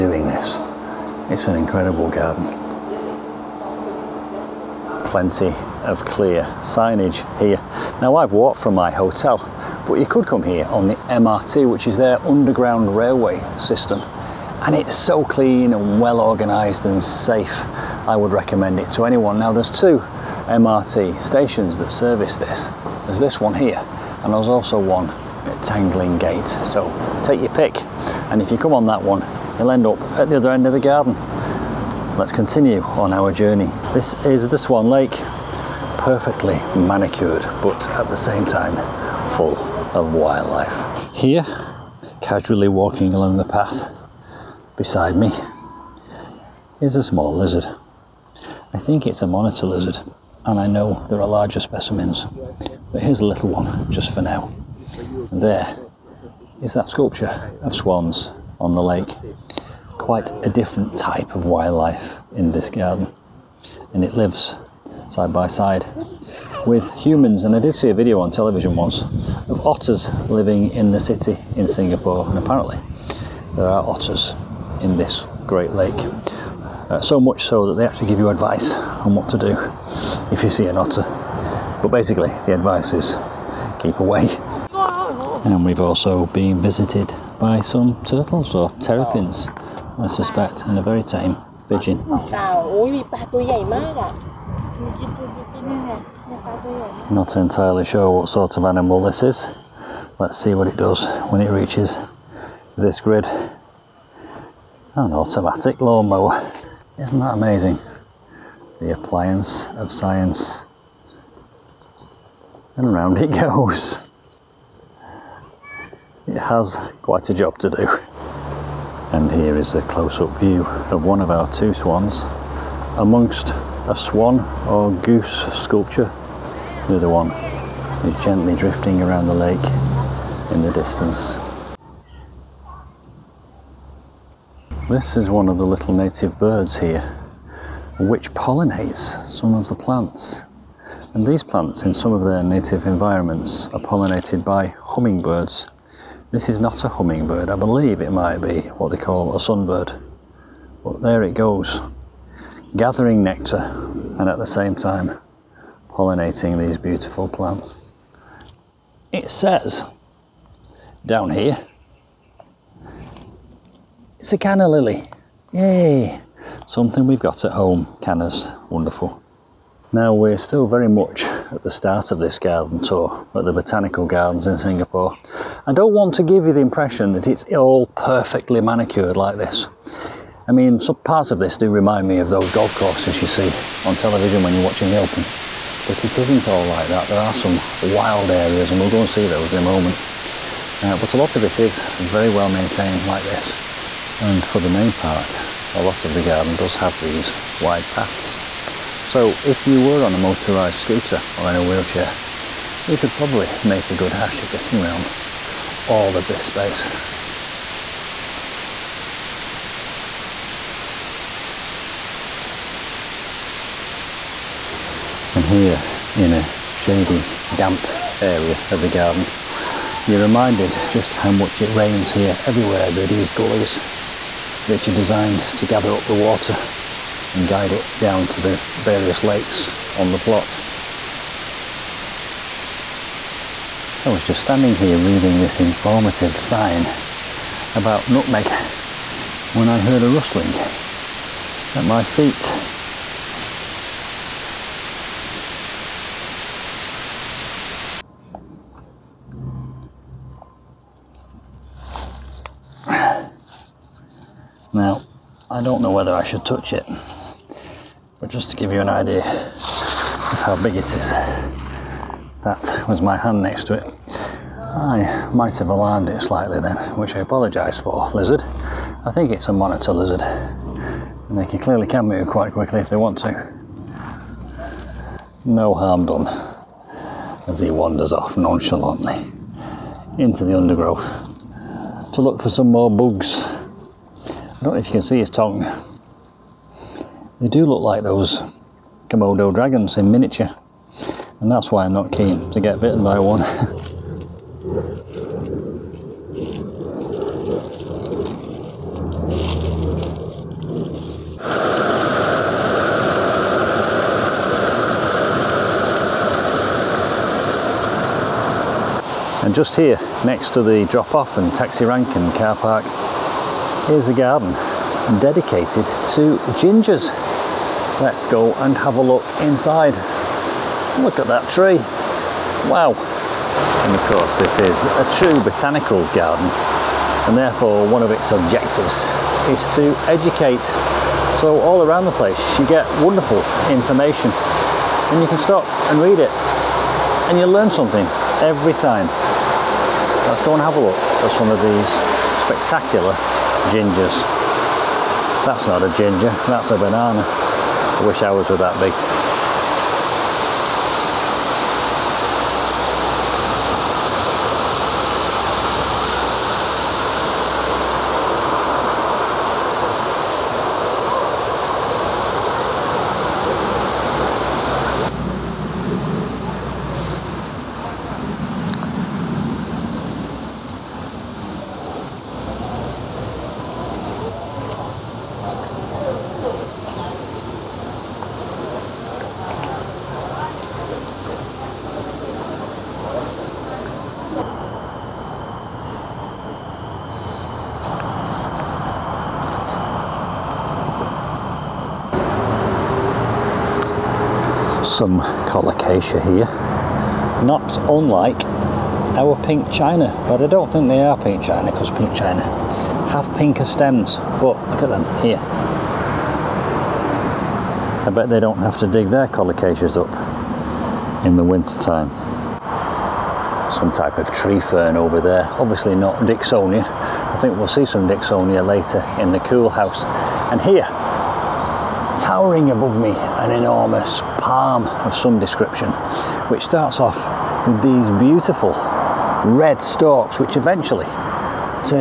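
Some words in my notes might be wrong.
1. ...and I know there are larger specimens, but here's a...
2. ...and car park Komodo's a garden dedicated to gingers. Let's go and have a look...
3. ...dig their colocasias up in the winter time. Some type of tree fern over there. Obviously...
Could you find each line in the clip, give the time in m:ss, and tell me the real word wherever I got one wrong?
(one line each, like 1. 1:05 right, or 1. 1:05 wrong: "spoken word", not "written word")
1. 0:50 right
2. 5:12 wrong: "Here", not "Komodo"
3. 6:48 right.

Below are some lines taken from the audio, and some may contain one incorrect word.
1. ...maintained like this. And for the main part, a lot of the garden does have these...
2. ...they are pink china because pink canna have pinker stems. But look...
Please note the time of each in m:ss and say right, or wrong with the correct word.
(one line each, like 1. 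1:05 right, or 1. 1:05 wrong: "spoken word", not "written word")
1. 3:12 right
2. 6:40 wrong: "china", not "canna".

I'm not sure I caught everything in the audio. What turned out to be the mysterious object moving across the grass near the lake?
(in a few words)
An automatic lawnmower.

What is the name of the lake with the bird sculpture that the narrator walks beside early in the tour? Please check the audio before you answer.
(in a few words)
Swan Lake.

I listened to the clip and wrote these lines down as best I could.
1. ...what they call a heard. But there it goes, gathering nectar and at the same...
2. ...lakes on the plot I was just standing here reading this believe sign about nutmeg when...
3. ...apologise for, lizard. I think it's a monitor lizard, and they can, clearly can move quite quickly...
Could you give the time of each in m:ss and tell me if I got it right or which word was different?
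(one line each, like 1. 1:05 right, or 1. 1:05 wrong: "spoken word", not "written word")
1. 2:28 wrong: "sunbird", not "heard"
2. 3:49 wrong: "informative", not "believe"
3. 4:27 right.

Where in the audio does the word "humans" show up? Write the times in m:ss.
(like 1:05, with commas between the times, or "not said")
1:06.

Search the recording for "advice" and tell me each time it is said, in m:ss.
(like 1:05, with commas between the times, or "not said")
1:18, 1:22.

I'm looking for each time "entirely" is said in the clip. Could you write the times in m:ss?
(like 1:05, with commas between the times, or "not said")
1:37.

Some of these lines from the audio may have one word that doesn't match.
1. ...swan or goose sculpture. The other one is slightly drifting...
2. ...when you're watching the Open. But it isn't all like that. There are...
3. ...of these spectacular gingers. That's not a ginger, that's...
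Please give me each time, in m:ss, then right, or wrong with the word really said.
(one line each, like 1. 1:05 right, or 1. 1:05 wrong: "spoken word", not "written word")
1. 2:03 wrong: "gently", not "slightly"
2. 3:04 right
3. 5:41 right.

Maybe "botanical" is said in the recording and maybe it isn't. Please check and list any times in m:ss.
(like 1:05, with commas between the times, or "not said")
2:53, 5:25.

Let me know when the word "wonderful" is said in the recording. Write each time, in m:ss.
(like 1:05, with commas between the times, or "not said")
2:48, 5:33.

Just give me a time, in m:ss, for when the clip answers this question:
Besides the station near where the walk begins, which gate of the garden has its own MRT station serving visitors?
0:25.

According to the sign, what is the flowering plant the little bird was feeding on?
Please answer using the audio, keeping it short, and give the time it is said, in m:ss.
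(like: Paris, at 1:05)
Canna lily, at 2:44.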